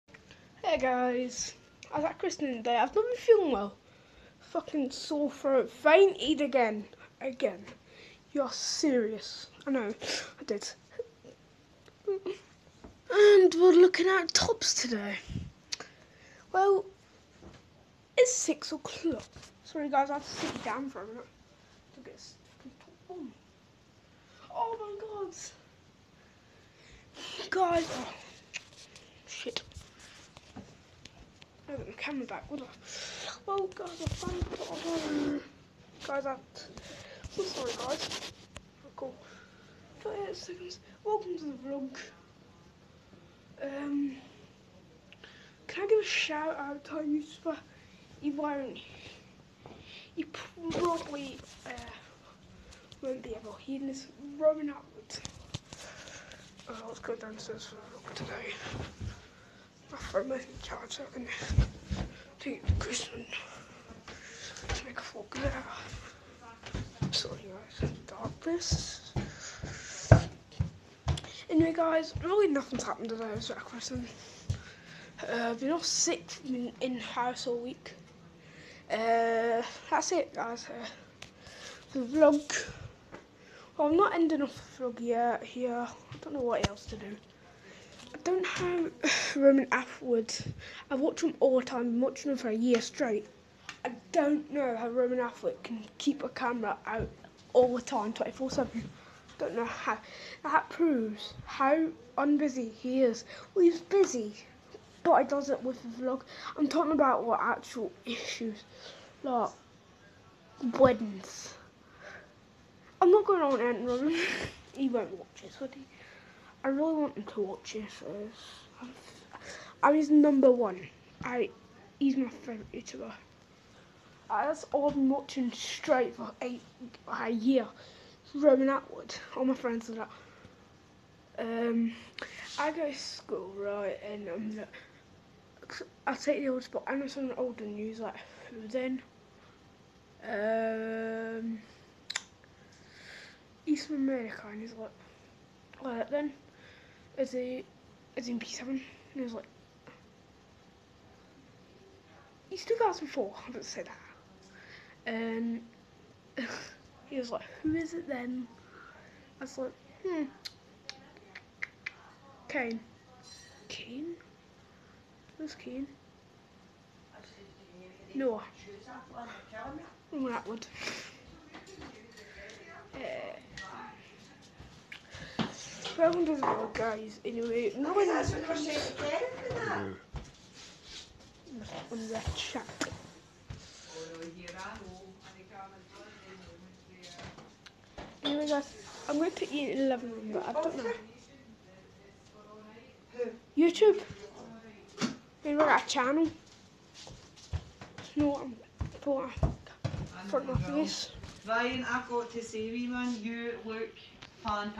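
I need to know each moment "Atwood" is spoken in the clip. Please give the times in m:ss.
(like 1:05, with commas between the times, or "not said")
1:29, 1:35, 2:08, 2:50.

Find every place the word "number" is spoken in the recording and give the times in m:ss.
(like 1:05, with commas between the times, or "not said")
2:00.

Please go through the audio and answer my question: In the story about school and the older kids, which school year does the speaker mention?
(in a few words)
P7.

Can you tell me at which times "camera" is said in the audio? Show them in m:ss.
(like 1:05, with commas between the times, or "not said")
0:31, 1:36.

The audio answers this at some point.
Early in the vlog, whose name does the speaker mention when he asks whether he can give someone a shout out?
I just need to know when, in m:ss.
0:46.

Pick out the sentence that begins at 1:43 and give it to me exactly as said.
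Well, he's busy, but he does it with the vlog.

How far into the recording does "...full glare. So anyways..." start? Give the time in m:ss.
1:05.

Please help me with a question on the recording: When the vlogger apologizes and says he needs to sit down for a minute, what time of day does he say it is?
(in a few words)
6 o'clock.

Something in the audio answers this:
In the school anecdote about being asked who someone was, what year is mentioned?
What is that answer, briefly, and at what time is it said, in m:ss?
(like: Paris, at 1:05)
2004, at 2:32.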